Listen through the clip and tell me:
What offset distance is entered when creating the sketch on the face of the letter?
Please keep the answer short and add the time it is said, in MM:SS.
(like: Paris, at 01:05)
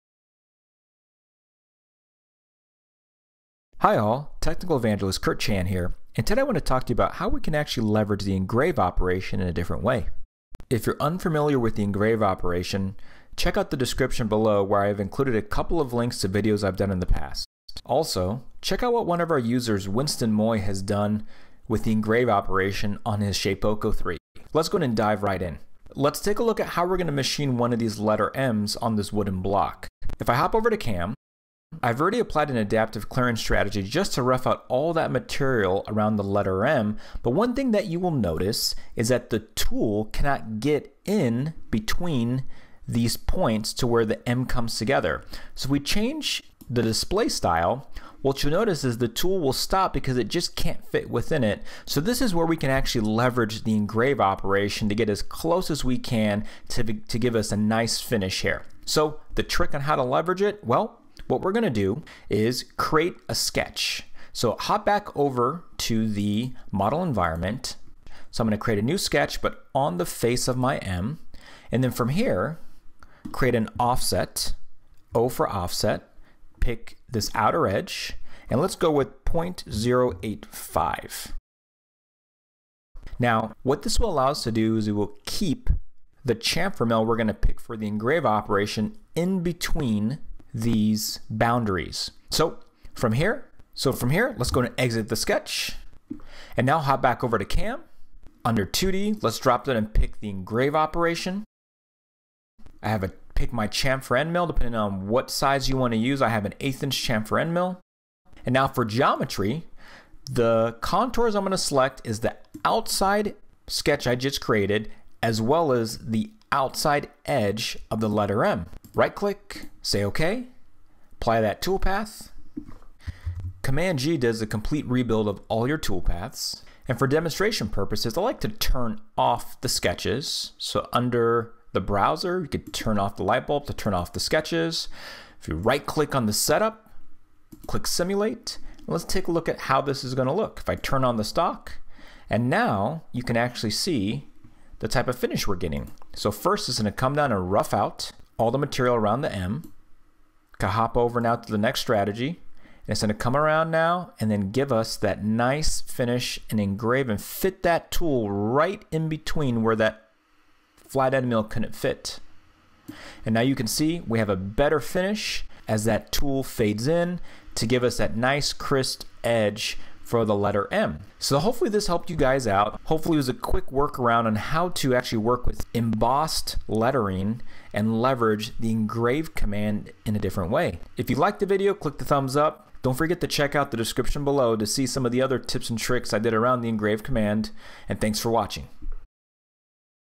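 0.085, at 01:19.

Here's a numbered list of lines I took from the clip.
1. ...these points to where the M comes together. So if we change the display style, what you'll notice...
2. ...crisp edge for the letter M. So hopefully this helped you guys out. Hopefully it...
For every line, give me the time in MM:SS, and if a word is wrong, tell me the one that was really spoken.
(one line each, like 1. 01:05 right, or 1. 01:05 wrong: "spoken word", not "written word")
1. 00:42 right
2. 02:48 right.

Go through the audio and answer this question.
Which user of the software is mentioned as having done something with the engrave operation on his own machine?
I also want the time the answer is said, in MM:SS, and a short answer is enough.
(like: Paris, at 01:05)
Winston Moy, at 00:19.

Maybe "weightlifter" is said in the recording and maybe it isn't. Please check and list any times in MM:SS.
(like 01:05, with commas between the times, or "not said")
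not said.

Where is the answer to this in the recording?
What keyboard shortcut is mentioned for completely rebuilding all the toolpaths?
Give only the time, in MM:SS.
02:03.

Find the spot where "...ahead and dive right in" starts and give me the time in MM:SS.
00:24.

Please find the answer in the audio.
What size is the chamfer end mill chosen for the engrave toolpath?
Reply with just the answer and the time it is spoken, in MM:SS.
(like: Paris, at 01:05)
1/8 inch, at 01:46.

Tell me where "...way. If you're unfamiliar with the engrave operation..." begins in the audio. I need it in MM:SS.
00:09.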